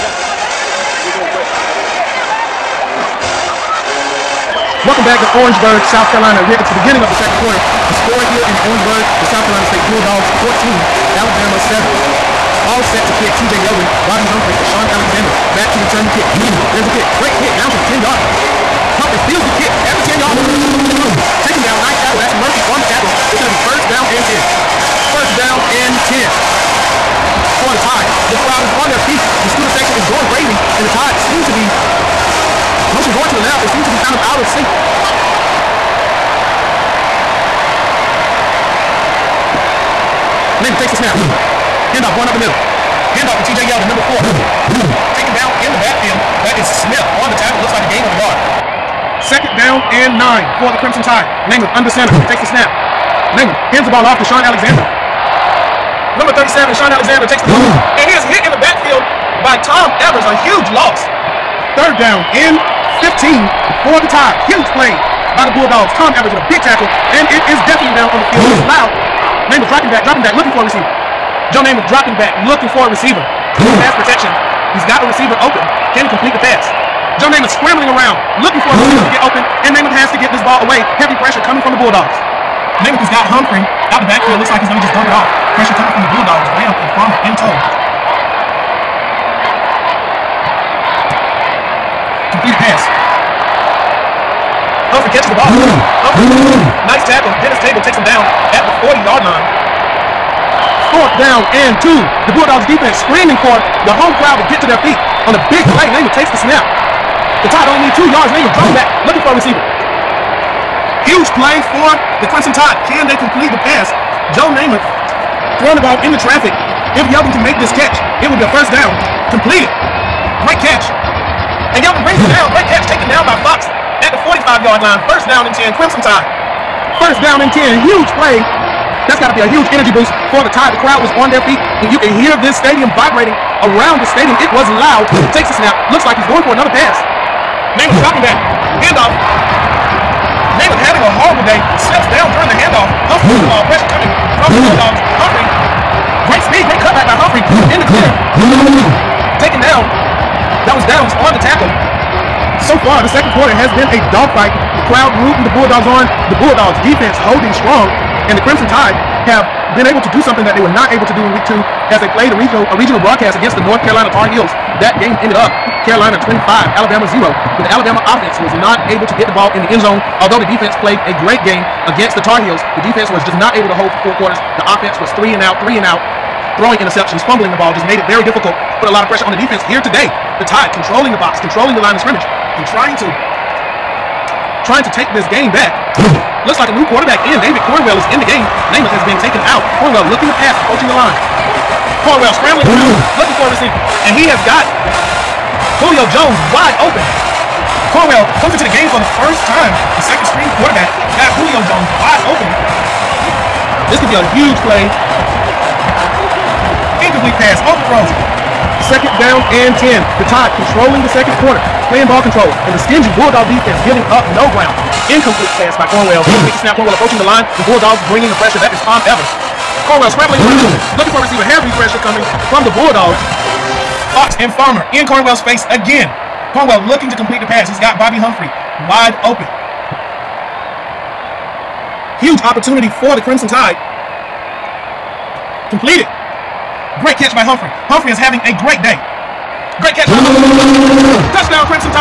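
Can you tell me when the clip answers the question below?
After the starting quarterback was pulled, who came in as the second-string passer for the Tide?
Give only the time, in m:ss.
3:07.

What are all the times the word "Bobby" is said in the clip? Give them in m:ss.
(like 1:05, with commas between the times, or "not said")
0:14, 3:47.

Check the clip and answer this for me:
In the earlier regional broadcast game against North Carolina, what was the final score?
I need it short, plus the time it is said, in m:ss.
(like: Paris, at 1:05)
Carolina 25, Alabama 0, at 2:45.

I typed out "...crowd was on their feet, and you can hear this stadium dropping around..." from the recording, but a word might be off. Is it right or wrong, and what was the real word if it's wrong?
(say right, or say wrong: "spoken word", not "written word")
wrong: "vibrating", not "dropping".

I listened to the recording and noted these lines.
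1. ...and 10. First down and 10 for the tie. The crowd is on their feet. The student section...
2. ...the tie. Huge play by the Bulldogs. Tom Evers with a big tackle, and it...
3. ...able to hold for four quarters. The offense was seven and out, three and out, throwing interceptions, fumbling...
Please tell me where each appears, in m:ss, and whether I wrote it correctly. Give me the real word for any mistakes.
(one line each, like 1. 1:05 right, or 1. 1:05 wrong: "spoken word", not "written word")
1. 0:24 right
2. 1:04 right
3. 2:53 wrong: "three", not "seven".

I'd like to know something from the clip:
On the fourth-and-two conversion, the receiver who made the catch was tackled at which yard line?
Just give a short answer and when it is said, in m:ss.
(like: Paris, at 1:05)
45-yard line, at 2:04.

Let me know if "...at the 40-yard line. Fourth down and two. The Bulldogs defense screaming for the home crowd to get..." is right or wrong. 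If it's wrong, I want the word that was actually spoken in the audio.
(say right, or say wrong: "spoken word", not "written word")
right.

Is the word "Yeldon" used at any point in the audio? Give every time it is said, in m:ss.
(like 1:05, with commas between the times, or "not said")
0:13, 0:43, 1:57, 2:01.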